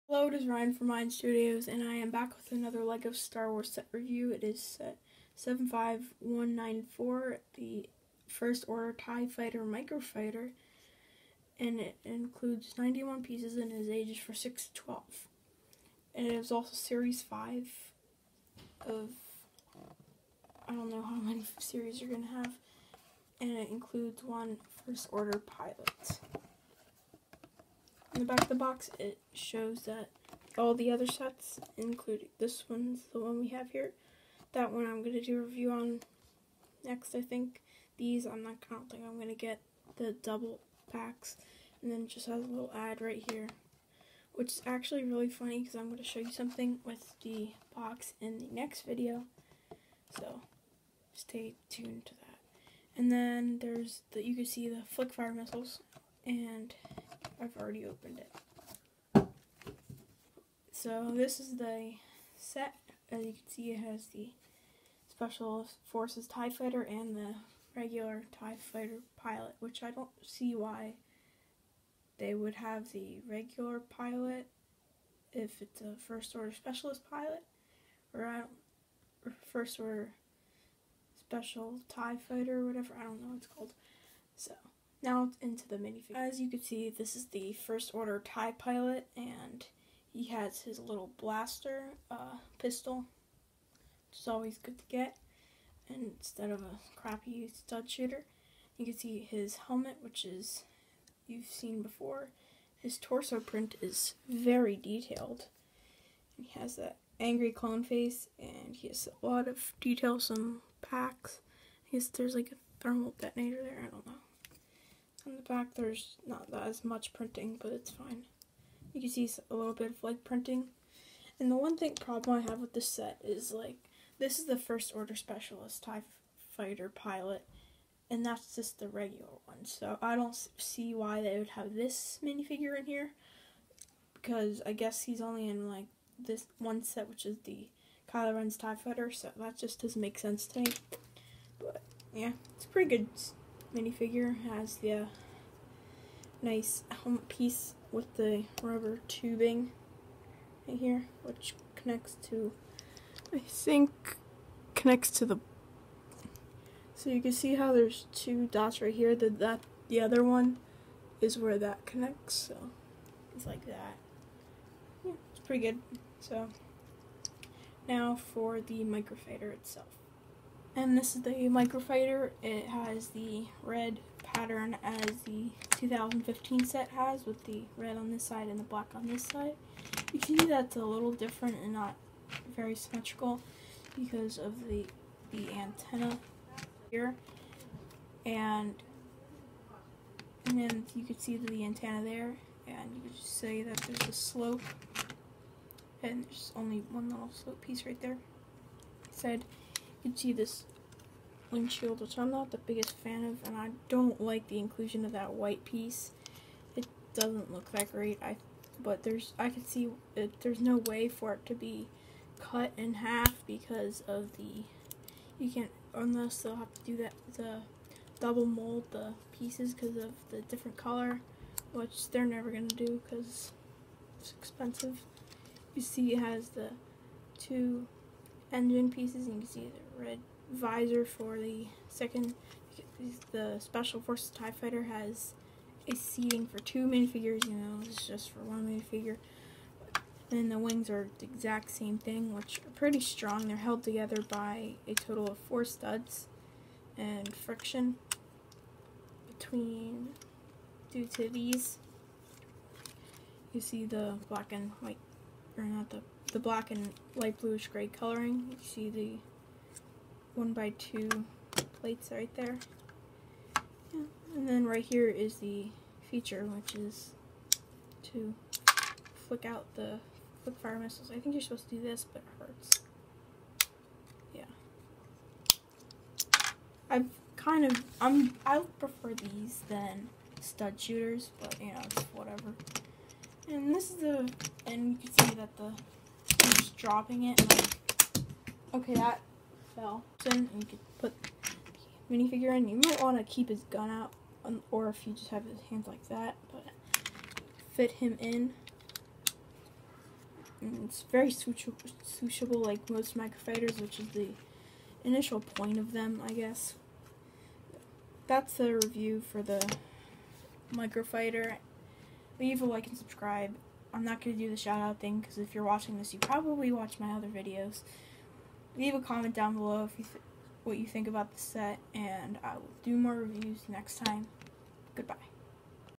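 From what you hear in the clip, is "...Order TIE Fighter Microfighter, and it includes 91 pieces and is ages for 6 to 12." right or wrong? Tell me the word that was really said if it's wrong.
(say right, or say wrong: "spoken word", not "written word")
right.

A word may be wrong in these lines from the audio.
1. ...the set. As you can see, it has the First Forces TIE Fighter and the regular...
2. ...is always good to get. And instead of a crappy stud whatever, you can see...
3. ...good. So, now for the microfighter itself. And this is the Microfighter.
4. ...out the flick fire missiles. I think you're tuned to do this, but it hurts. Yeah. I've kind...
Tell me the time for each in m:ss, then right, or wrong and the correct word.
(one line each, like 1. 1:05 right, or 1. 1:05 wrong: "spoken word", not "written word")
1. 1:01 wrong: "Special", not "First"
2. 1:34 wrong: "shooter", not "whatever"
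3. 2:45 right
4. 4:29 wrong: "supposed", not "tuned".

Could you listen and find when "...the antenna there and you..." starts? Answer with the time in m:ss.
3:11.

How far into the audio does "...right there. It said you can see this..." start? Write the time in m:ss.
3:17.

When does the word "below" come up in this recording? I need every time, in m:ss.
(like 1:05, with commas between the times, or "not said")
5:19.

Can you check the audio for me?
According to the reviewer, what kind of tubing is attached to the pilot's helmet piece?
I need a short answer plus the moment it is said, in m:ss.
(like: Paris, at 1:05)
rubber tubing, at 2:28.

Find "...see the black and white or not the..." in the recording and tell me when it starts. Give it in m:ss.
4:13.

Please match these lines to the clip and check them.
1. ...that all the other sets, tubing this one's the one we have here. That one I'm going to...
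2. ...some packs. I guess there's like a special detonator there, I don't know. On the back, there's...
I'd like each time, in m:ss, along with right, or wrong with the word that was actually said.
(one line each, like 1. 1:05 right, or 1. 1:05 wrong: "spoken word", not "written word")
1. 0:29 wrong: "including", not "tubing"
2. 1:50 wrong: "thermal", not "special".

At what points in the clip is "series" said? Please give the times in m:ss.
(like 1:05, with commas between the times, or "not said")
0:16, 0:21.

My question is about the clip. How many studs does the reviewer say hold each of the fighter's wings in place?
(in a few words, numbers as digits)
4.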